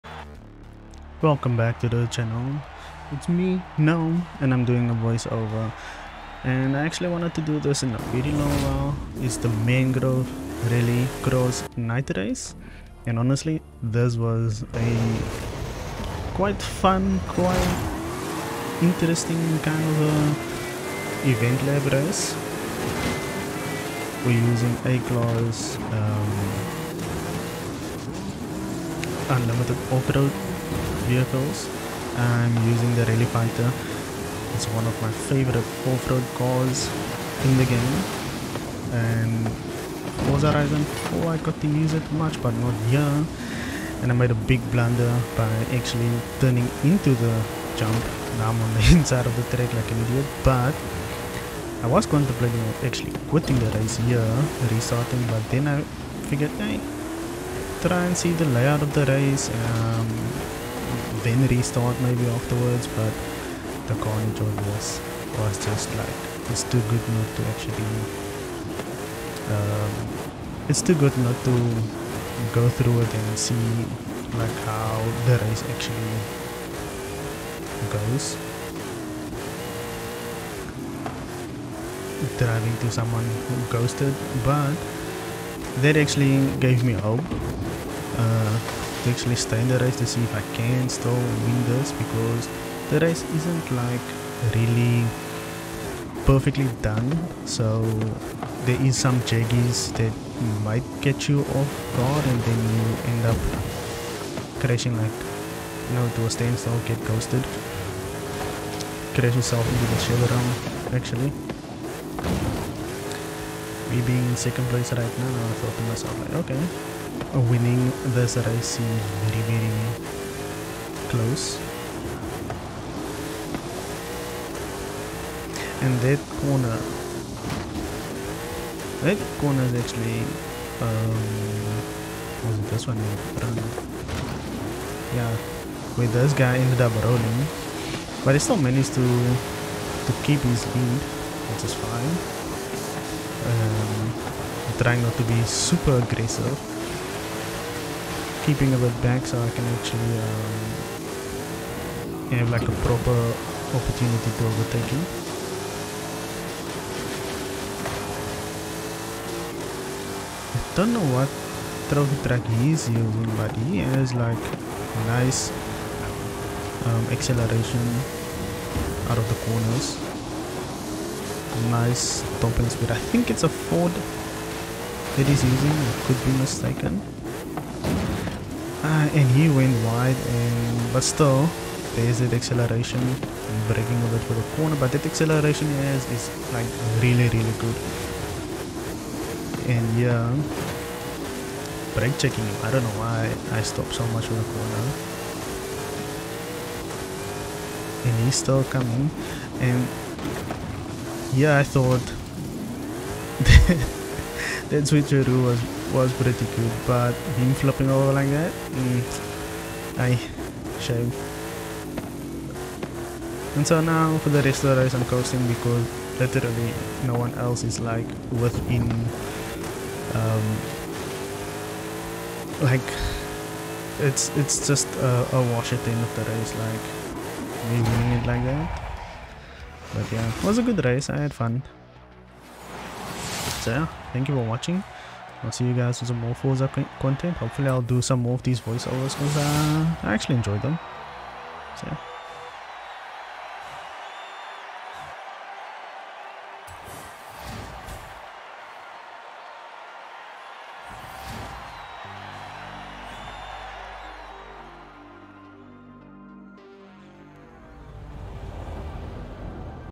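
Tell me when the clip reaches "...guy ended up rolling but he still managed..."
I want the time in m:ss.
2:16.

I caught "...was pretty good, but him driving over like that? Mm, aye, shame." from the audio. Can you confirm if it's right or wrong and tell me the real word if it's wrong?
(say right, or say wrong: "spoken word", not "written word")
wrong: "flopping", not "driving".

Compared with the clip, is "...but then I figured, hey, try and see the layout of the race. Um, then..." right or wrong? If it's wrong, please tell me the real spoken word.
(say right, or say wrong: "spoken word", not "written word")
right.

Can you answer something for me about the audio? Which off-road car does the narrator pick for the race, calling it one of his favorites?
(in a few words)
Rally Fighter.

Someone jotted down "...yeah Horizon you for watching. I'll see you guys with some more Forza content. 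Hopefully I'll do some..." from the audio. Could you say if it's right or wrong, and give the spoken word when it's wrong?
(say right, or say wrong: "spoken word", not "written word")
wrong: "Thank", not "Horizon".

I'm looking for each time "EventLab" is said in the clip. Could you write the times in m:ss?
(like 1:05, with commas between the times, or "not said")
0:21.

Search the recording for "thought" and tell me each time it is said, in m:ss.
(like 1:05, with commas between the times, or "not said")
1:55, 3:21.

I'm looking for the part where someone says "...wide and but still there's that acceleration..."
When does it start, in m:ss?
2:59.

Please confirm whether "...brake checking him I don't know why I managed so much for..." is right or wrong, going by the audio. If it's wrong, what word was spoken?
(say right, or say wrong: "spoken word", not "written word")
wrong: "stopped", not "managed".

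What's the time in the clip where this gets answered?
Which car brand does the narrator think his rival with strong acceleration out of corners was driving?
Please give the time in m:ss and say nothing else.
2:53.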